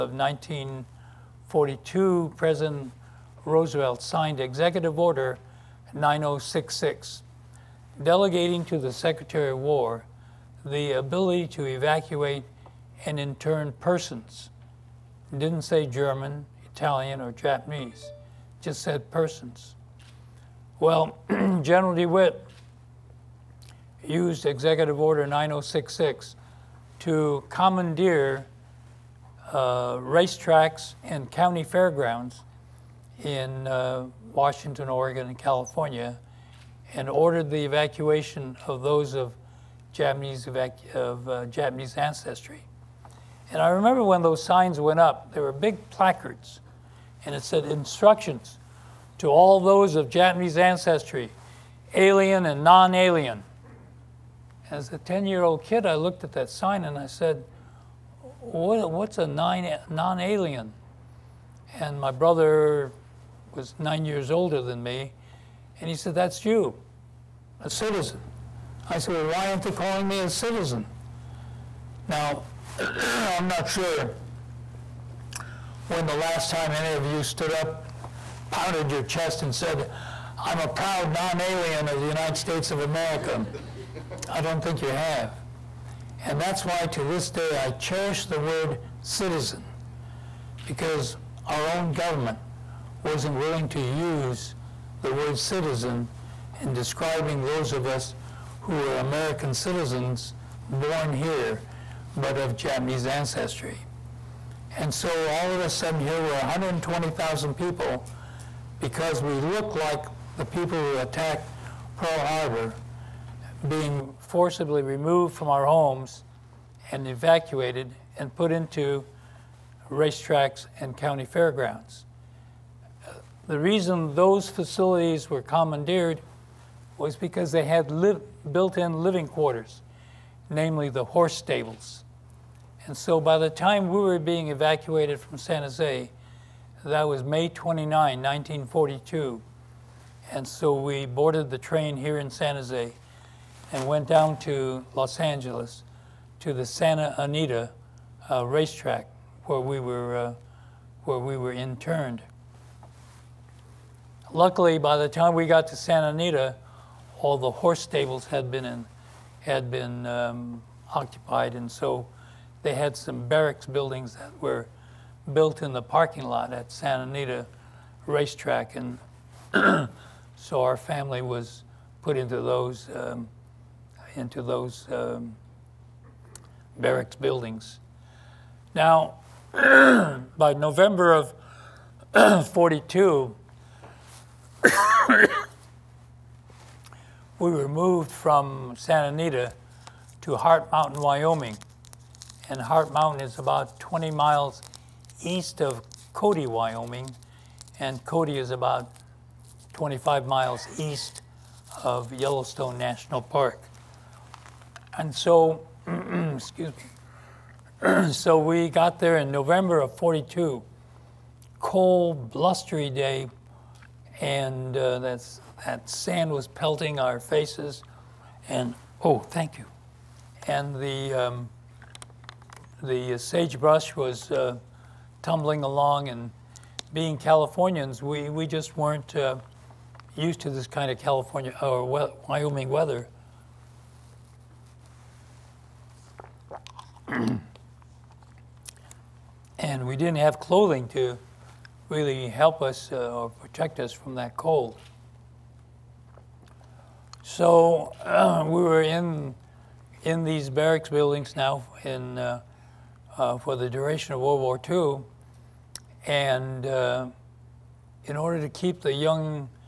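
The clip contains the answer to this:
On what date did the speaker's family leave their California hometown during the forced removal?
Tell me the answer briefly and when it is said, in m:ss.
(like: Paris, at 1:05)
May 29, 1942, at 2:17.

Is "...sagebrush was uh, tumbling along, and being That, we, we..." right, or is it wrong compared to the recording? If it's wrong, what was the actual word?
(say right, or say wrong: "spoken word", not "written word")
wrong: "Californians", not "That".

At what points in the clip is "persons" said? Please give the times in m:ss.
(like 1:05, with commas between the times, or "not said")
0:13, 0:19.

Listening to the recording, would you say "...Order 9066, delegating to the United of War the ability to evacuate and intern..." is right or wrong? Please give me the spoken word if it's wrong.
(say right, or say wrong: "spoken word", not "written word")
wrong: "Secretary", not "United".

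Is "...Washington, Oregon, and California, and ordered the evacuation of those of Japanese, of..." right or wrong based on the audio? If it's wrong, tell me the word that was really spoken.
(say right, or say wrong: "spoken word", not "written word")
right.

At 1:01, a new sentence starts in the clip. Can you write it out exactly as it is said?
And my brother was nine years older than me.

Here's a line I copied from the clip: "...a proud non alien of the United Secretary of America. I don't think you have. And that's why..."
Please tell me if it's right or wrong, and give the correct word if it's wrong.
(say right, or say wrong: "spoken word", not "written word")
wrong: "States", not "Secretary".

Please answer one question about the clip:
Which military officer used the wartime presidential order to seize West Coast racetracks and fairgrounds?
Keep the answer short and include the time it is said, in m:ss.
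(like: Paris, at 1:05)
General DeWitt, at 0:21.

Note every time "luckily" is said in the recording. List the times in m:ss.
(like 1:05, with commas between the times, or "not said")
2:34.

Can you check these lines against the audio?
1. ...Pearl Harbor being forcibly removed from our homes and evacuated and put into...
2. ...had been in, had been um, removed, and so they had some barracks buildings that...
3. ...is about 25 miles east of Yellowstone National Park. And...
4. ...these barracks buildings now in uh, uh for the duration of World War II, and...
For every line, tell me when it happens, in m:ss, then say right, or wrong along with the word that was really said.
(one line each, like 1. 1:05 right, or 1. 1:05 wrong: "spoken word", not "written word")
1. 1:51 right
2. 2:38 wrong: "occupied", not "removed"
3. 3:18 right
4. 4:10 right.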